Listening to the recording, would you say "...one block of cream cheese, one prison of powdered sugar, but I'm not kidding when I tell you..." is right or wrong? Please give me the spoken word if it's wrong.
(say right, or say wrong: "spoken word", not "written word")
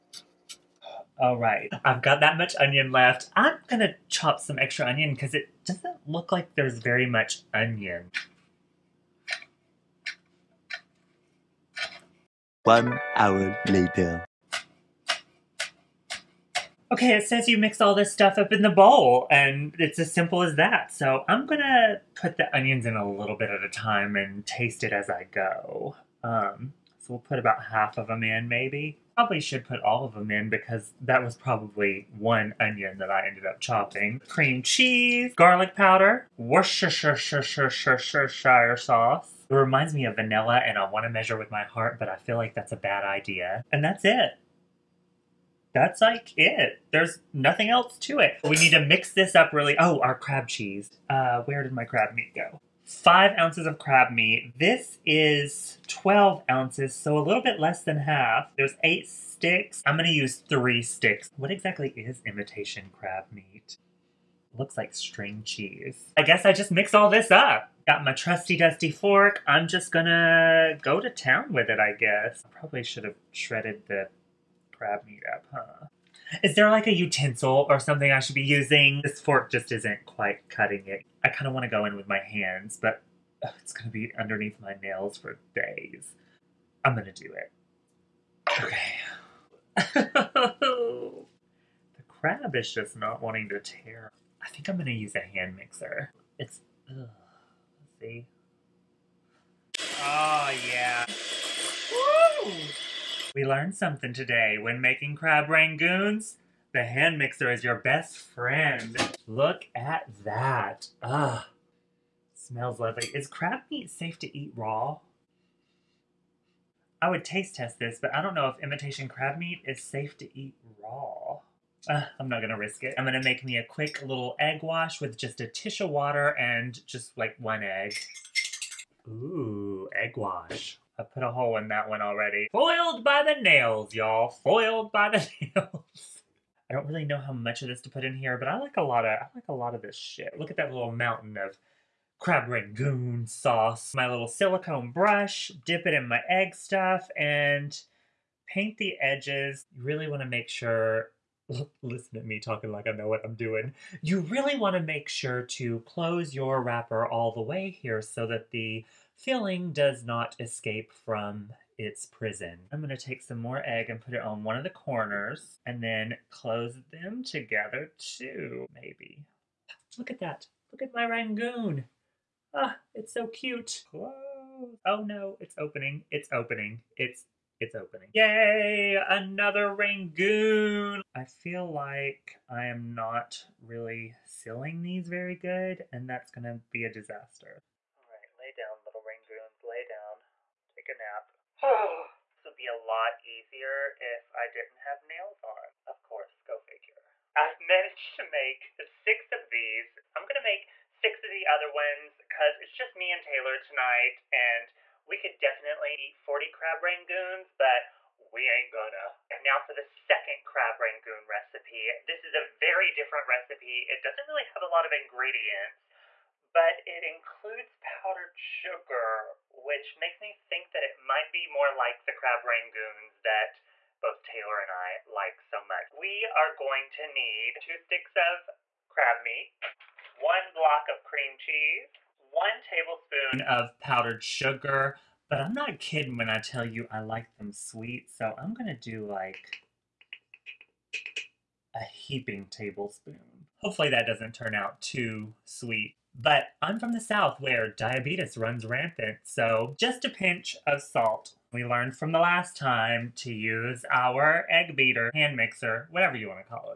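wrong: "tablespoon", not "prison".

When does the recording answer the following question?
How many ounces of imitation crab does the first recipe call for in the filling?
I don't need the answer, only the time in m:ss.
0:52.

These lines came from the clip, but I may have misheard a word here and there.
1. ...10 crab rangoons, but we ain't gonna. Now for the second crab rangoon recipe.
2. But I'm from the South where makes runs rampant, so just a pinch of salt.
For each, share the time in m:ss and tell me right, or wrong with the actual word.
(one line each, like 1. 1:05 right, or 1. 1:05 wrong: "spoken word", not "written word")
1. 3:26 wrong: "40", not "10"
2. 4:06 wrong: "diabetes", not "makes".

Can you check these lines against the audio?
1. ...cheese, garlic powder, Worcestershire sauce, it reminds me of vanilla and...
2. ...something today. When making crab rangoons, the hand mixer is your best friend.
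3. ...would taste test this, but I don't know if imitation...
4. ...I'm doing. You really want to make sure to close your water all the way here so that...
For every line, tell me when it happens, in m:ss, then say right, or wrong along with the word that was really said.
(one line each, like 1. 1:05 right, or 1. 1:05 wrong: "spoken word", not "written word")
1. 0:34 right
2. 1:43 right
3. 1:57 right
4. 2:33 wrong: "wrapper", not "water".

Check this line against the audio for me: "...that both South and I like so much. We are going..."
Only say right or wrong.
wrong.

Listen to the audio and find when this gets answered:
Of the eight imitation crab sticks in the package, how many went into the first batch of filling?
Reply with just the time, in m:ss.
1:00.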